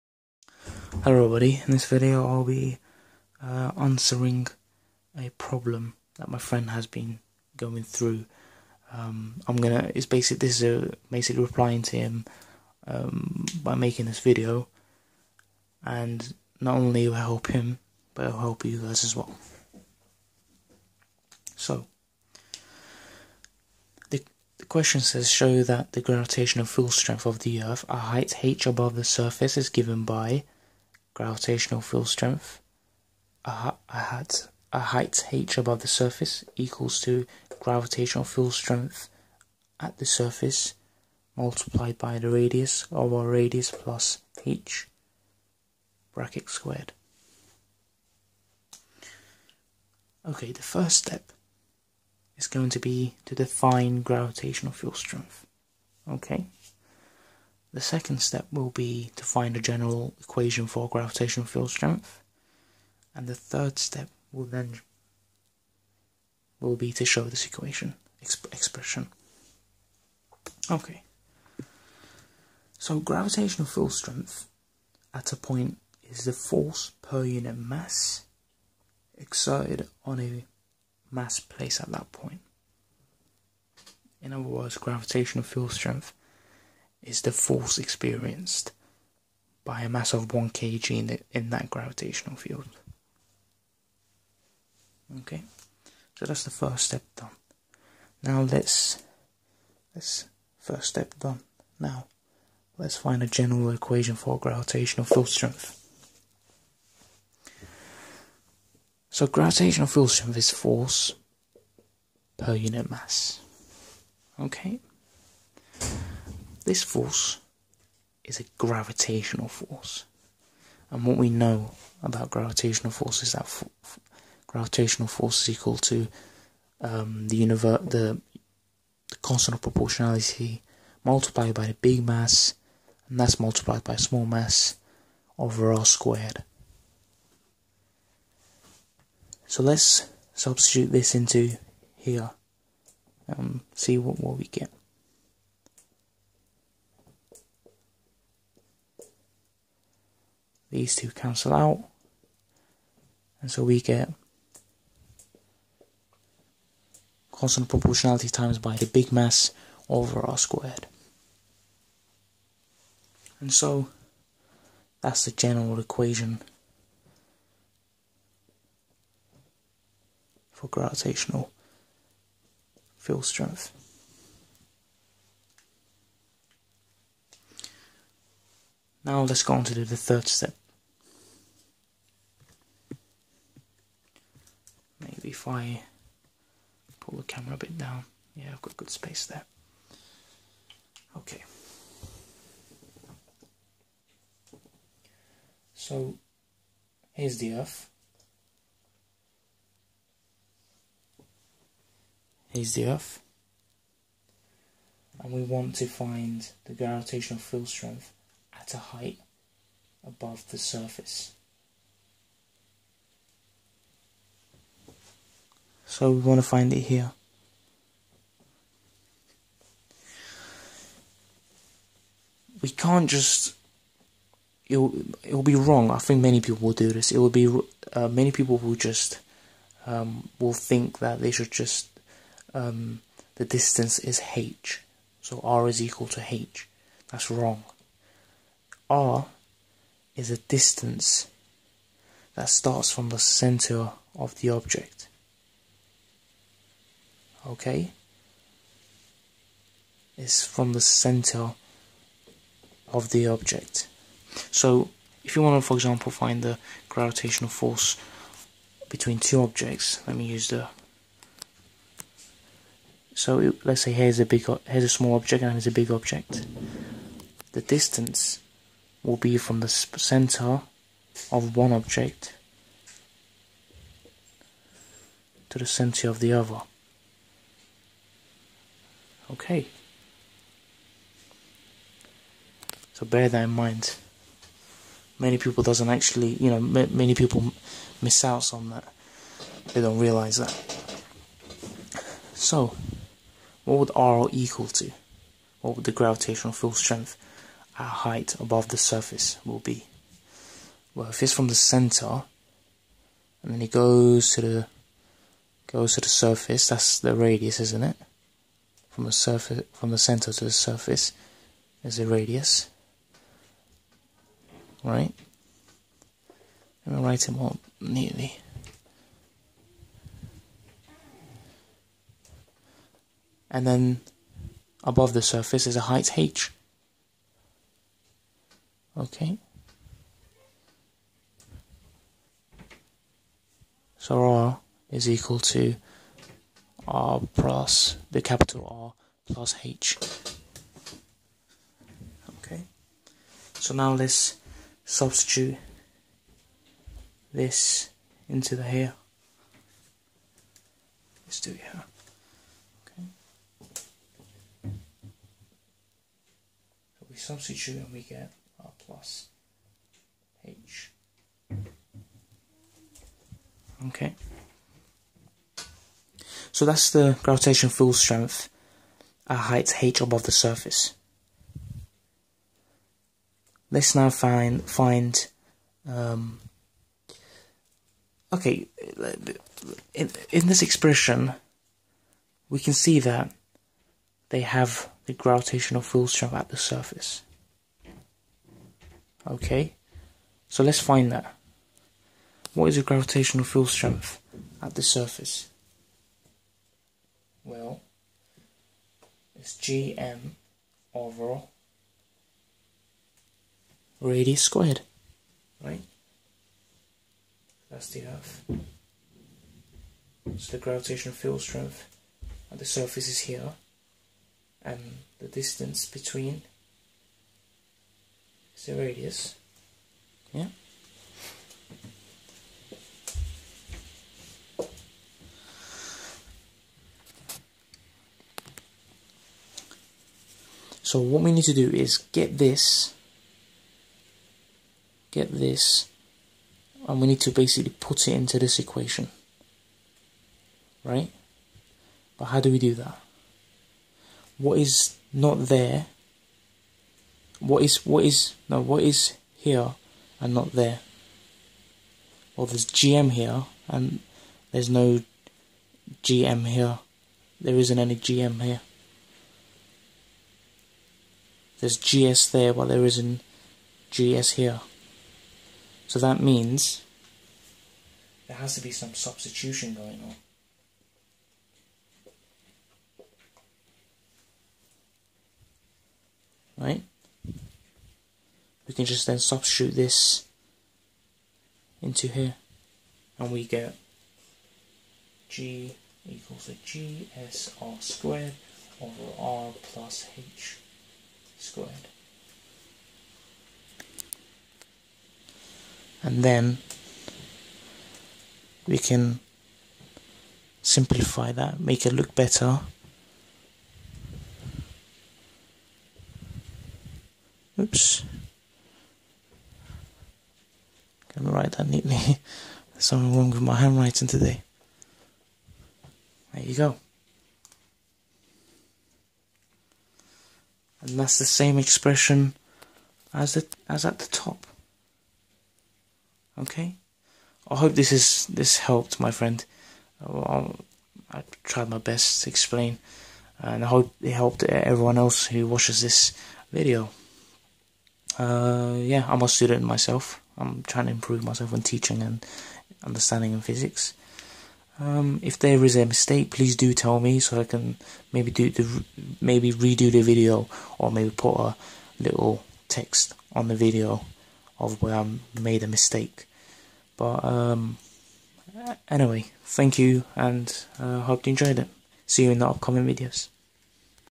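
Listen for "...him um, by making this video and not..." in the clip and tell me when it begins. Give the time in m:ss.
0:11.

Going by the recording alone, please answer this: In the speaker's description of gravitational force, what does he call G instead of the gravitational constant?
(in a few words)
constant of proportionality.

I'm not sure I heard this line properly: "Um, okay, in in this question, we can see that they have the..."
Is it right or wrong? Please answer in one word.
wrong.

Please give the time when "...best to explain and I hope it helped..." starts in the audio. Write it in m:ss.
8:51.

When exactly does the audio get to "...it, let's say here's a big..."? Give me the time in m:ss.
4:23.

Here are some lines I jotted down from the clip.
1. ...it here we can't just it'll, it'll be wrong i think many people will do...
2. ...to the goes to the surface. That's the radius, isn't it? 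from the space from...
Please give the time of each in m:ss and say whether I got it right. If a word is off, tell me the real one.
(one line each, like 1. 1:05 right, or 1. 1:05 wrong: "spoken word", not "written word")
1. 3:36 right
2. 5:04 wrong: "surface", not "space".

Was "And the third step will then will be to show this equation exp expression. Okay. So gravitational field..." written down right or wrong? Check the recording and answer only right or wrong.
right.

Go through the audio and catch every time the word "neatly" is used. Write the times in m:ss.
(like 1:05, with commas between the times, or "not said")
5:17, 8:31.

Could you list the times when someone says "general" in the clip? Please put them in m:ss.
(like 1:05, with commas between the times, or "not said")
0:59, 1:43, 2:45.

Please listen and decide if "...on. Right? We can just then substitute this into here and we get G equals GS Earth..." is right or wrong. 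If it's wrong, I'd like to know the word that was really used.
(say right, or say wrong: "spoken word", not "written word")
wrong: "GSR", not "Earth".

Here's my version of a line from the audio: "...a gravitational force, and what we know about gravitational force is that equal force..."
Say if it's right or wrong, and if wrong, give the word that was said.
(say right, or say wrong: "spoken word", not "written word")
wrong: "gravitational", not "equal".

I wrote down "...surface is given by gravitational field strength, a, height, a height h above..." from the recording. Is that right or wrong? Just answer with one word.
right.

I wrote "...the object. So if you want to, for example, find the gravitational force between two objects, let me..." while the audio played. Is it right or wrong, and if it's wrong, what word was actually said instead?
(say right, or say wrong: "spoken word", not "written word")
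right.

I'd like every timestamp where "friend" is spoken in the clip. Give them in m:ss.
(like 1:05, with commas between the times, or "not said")
0:06, 8:49.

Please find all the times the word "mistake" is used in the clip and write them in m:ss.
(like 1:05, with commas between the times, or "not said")
9:05, 9:15.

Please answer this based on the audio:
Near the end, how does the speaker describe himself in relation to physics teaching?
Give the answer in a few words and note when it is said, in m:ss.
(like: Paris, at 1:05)
a student, at 8:59.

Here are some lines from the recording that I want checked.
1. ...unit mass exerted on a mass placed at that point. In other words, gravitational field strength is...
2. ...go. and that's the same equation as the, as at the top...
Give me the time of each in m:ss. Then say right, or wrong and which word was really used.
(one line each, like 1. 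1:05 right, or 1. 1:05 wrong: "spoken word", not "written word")
1. 1:17 right
2. 8:36 wrong: "expression", not "equation".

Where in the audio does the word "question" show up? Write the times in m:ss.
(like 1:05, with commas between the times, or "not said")
0:24.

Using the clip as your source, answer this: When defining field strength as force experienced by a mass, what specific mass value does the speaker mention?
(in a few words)
1 kg.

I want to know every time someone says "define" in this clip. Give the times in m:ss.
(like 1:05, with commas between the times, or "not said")
0:53.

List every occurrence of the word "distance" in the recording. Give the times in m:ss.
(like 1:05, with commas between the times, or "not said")
3:53, 4:00, 4:27, 6:55.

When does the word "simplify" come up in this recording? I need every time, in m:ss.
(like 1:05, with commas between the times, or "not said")
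8:20.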